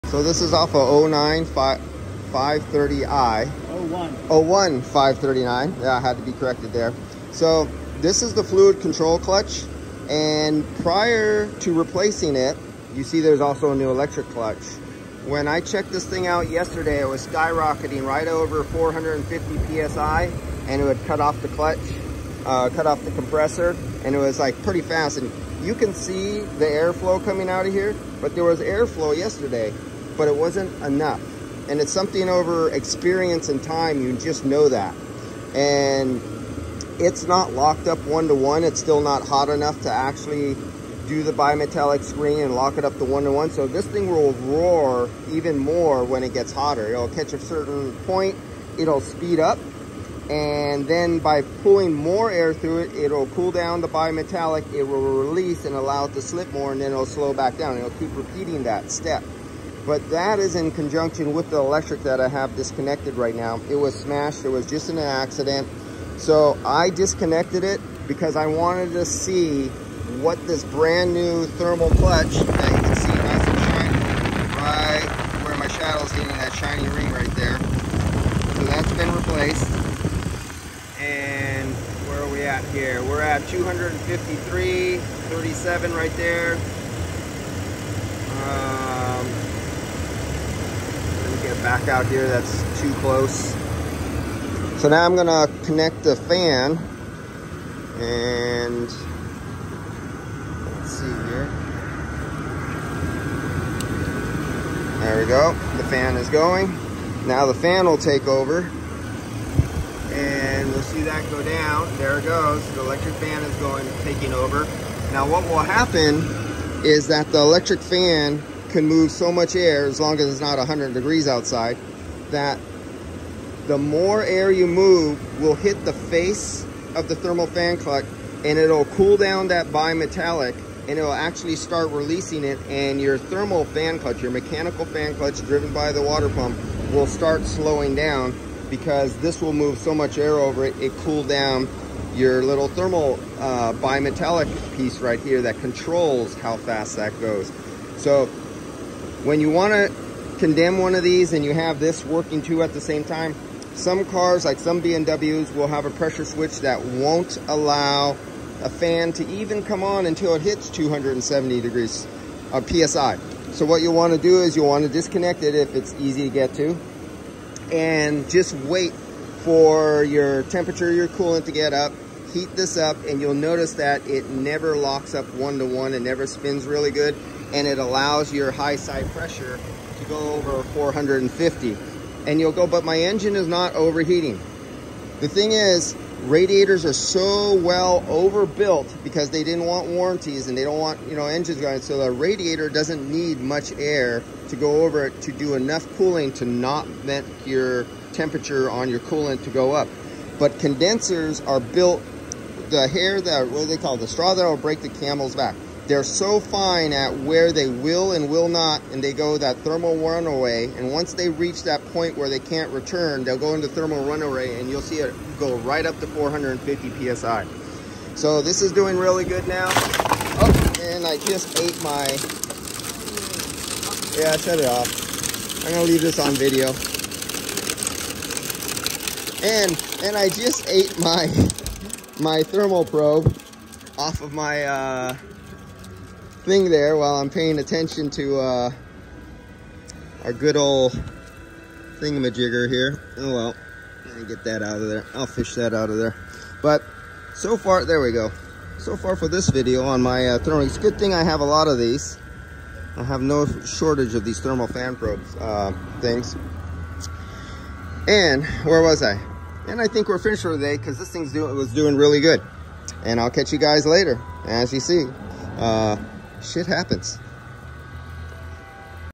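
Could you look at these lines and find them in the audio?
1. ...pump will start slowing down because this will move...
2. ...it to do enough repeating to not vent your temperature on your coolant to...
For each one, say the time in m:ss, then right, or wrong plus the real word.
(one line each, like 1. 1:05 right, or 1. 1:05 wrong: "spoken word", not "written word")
1. 2:16 right
2. 3:15 wrong: "cooling", not "repeating".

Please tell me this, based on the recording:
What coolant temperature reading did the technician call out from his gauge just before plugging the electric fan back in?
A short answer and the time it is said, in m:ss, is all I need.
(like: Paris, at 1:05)
253, at 1:23.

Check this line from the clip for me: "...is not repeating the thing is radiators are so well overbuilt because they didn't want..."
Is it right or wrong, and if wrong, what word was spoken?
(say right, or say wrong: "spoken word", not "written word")
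wrong: "overheating", not "repeating".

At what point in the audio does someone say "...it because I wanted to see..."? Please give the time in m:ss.
1:07.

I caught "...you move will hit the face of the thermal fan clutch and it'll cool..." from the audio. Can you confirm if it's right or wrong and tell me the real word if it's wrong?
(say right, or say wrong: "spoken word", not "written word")
right.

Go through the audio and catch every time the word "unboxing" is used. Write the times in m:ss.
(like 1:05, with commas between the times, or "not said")
not said.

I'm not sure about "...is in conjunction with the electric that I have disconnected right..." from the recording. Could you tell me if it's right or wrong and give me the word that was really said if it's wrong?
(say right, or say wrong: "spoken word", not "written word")
right.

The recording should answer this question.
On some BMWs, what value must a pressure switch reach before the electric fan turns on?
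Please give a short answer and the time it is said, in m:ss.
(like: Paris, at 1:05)
270, at 2:40.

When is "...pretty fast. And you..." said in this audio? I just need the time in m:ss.
0:24.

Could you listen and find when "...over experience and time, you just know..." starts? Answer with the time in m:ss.
0:32.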